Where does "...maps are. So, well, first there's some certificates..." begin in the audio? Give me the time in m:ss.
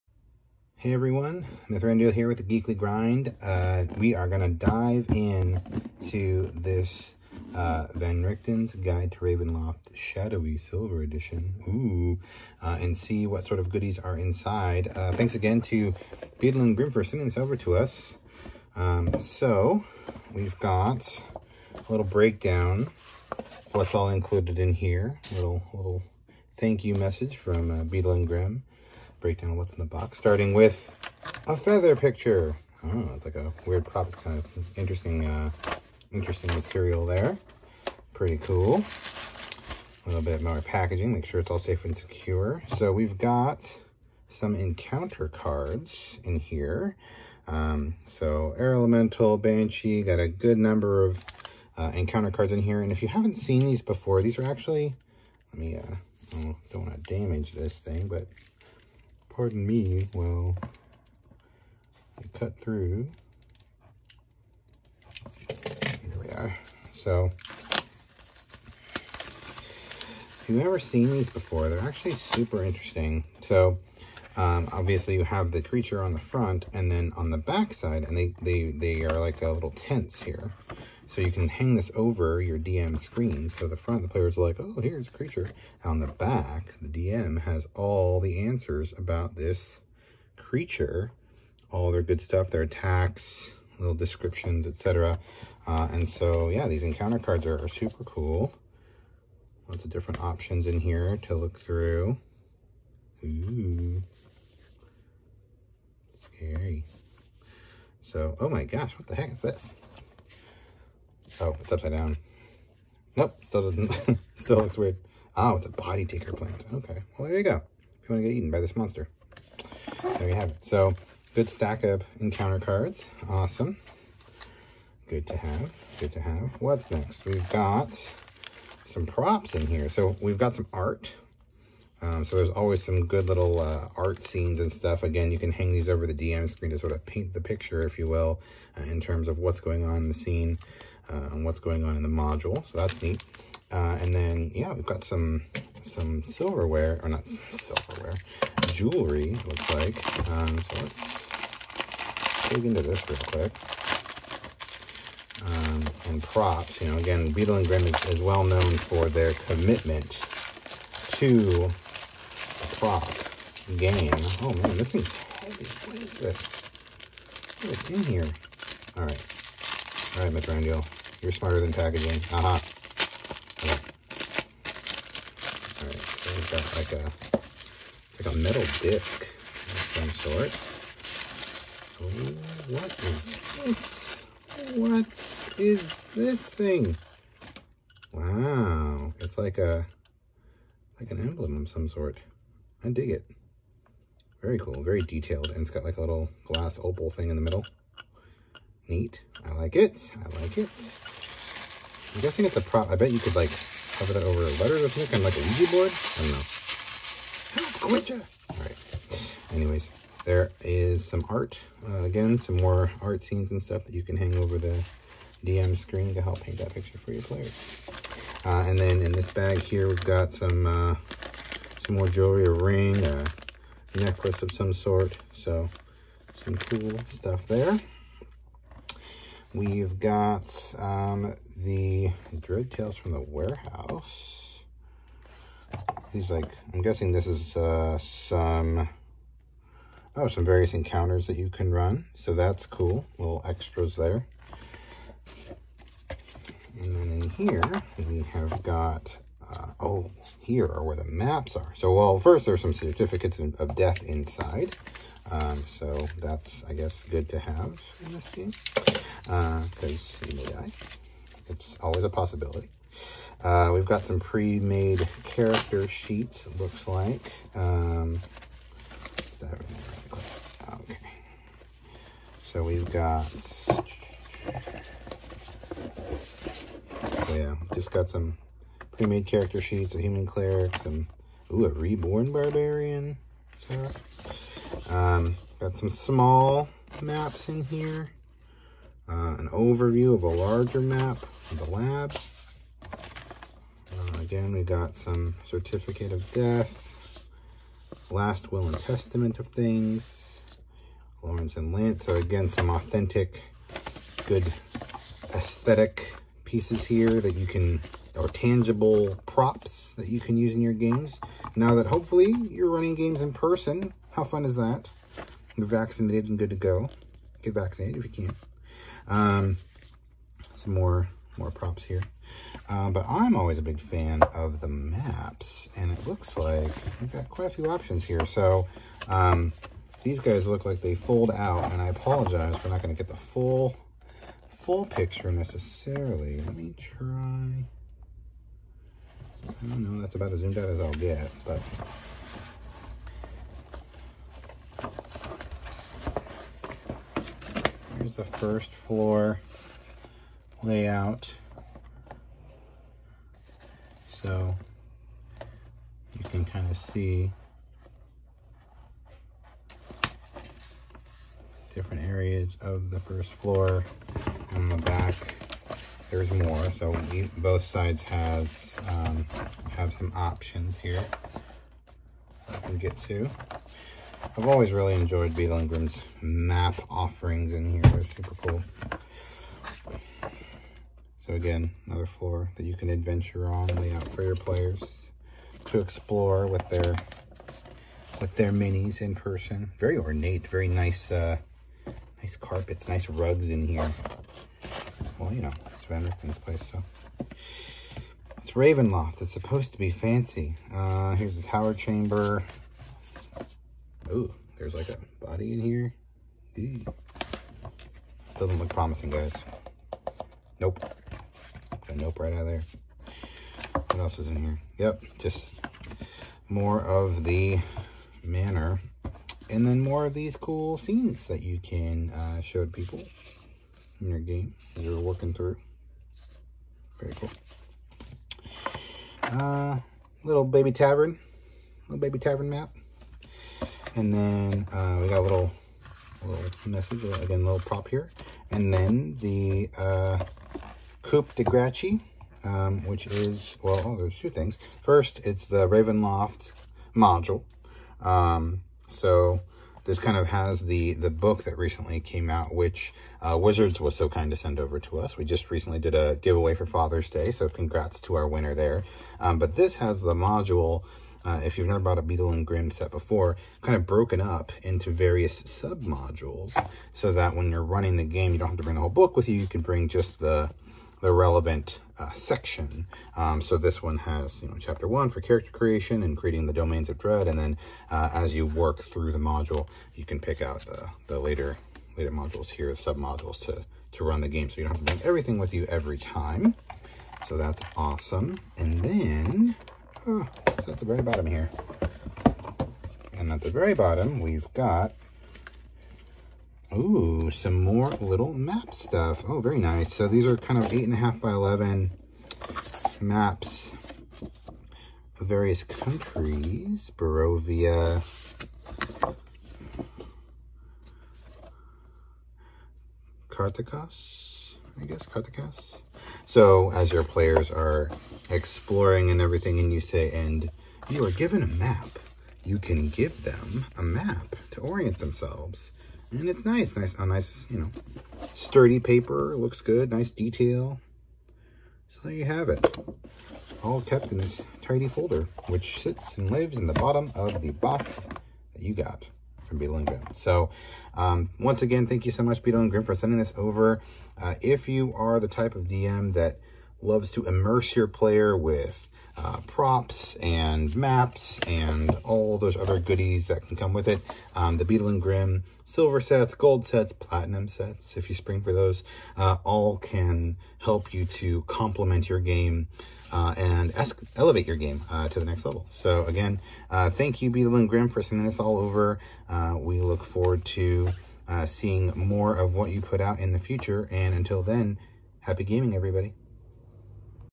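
4:11.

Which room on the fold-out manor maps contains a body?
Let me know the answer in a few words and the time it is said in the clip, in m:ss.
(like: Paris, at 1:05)
Tower chamber, at 6:41.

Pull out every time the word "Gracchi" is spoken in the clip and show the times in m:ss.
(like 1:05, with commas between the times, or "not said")
7:21.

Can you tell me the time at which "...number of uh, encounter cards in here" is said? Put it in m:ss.
0:50.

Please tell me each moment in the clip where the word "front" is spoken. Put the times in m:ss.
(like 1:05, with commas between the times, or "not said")
1:16, 1:23.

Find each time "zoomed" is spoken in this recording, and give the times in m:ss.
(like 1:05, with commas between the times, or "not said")
5:40.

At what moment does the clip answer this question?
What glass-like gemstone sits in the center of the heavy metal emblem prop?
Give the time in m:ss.
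3:16.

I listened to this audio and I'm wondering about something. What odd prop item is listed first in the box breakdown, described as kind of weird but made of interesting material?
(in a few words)
A feather picture.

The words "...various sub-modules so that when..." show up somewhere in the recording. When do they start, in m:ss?
7:44.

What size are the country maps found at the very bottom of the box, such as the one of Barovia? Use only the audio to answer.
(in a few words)
8.5 by 11.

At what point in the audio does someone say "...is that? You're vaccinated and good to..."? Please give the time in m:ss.
5:14.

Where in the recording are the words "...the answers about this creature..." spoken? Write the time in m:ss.
1:28.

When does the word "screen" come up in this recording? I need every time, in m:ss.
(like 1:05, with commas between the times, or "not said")
1:22, 2:16, 3:35.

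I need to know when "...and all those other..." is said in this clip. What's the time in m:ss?
9:11.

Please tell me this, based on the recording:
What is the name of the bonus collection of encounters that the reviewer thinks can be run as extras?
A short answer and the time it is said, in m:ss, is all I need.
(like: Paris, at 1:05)
Dread Tales from the Warehouse, at 3:52.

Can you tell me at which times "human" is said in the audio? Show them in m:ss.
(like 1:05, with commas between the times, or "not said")
4:40.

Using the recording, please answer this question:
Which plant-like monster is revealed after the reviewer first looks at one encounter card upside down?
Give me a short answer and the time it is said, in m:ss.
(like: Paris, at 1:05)
Body taker plant, at 1:55.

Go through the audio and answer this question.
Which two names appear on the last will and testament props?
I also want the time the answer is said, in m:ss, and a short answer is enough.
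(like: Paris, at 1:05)
Lawrence and Lance, at 5:01.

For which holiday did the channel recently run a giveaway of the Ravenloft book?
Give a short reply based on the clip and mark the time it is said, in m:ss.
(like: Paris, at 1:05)
Father's Day, at 7:36.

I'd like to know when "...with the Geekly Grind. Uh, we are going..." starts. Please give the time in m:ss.
0:02.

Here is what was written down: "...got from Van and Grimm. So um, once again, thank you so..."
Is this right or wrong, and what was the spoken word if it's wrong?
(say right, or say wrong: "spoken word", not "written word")
wrong: "Beadle", not "Van".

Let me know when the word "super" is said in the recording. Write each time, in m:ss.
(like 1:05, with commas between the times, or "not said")
1:12, 1:37, 6:18.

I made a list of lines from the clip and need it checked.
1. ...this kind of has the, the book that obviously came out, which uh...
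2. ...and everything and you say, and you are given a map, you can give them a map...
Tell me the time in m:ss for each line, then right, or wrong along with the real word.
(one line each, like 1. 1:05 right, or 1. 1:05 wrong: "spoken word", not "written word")
1. 7:29 wrong: "recently", not "obviously"
2. 8:39 right.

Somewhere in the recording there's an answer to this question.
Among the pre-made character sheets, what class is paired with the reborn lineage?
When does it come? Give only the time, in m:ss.
4:42.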